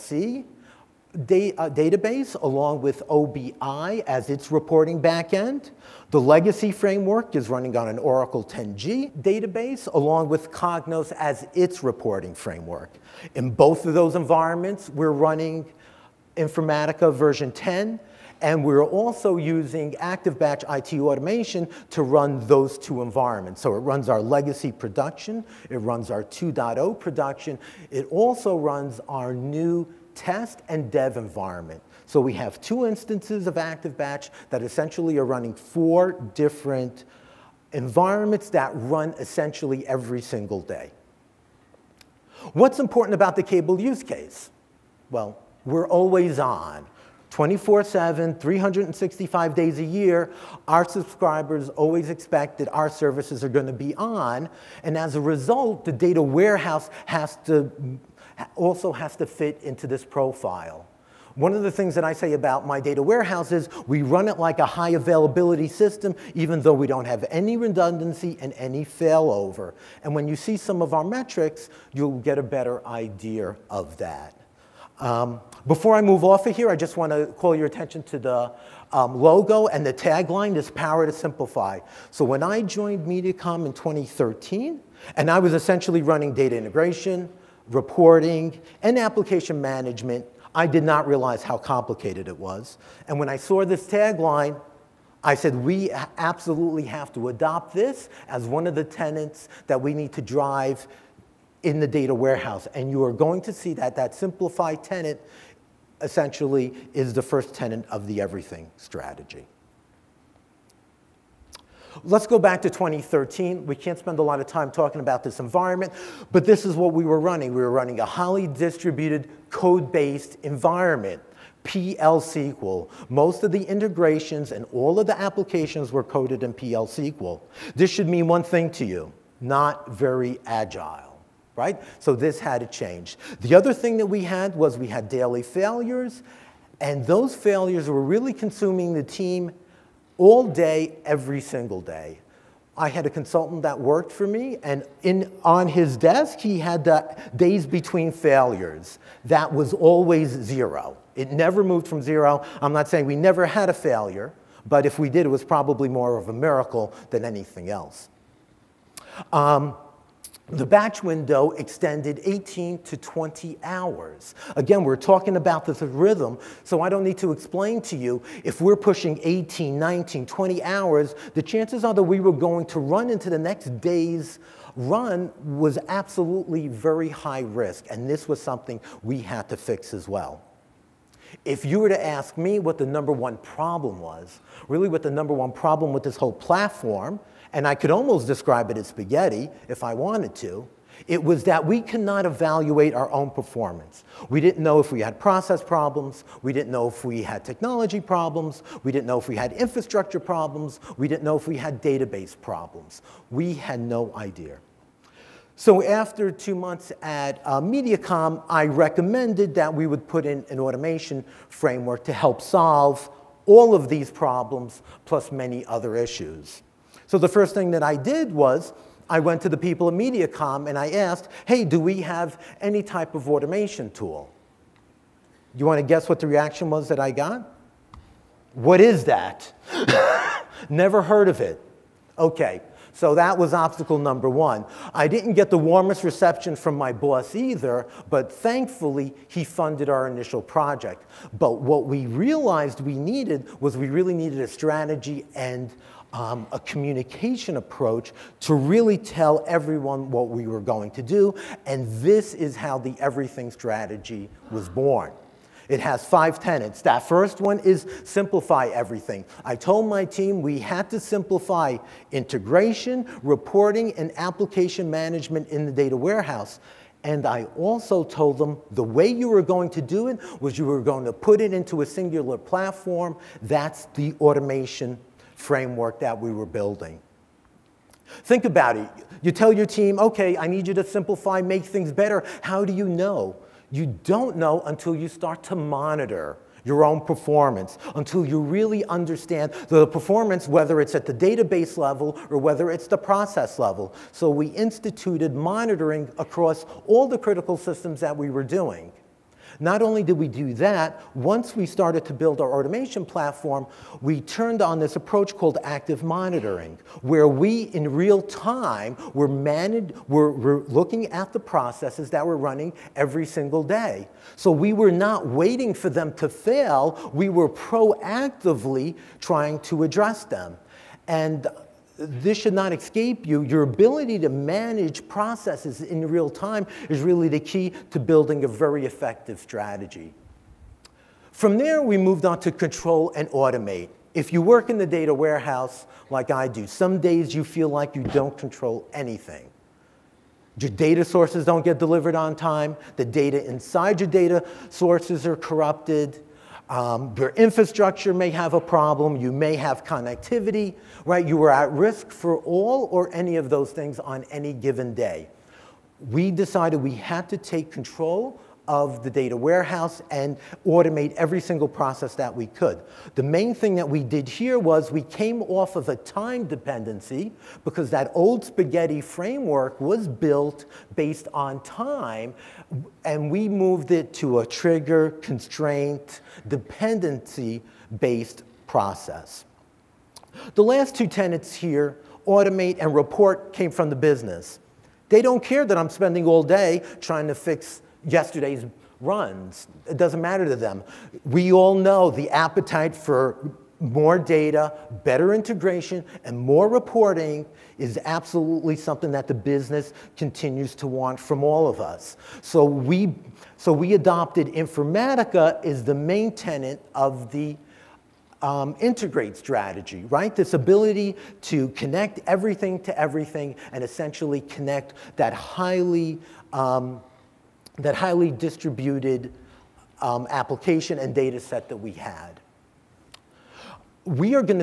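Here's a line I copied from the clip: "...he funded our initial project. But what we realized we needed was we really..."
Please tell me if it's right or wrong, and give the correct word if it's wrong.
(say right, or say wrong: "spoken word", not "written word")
right.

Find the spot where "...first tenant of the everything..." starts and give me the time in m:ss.
1:47.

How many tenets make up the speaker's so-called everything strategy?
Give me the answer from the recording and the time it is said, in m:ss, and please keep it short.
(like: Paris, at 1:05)
5, at 4:16.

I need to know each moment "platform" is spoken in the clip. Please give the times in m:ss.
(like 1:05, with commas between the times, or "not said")
3:06, 4:32, 5:03.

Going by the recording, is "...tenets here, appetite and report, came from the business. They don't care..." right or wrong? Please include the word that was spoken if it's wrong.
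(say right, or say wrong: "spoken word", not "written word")
wrong: "automate", not "appetite".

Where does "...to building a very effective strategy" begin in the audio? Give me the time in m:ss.
5:27.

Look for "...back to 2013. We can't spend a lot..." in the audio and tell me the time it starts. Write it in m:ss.
1:52.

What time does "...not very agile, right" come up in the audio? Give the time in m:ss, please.
2:09.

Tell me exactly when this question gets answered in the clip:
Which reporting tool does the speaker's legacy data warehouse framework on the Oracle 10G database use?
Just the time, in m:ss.
0:10.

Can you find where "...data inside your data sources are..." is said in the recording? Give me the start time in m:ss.
5:43.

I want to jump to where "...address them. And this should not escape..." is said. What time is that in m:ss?
5:19.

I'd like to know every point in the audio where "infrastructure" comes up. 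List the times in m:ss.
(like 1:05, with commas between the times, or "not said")
3:19, 5:47.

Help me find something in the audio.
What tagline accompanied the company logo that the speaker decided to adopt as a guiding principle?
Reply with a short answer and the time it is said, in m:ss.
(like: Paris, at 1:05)
Power to simplify, at 1:20.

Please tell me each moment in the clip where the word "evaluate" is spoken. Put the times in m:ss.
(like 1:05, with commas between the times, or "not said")
3:12.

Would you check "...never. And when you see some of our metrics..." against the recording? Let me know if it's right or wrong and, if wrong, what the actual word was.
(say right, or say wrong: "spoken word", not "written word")
wrong: "failover", not "never".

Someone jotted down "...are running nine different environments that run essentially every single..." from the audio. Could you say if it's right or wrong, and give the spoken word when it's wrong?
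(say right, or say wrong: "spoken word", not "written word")
wrong: "four", not "nine".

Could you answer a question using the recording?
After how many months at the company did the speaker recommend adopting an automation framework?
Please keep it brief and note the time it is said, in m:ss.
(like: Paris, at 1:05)
2, at 3:26.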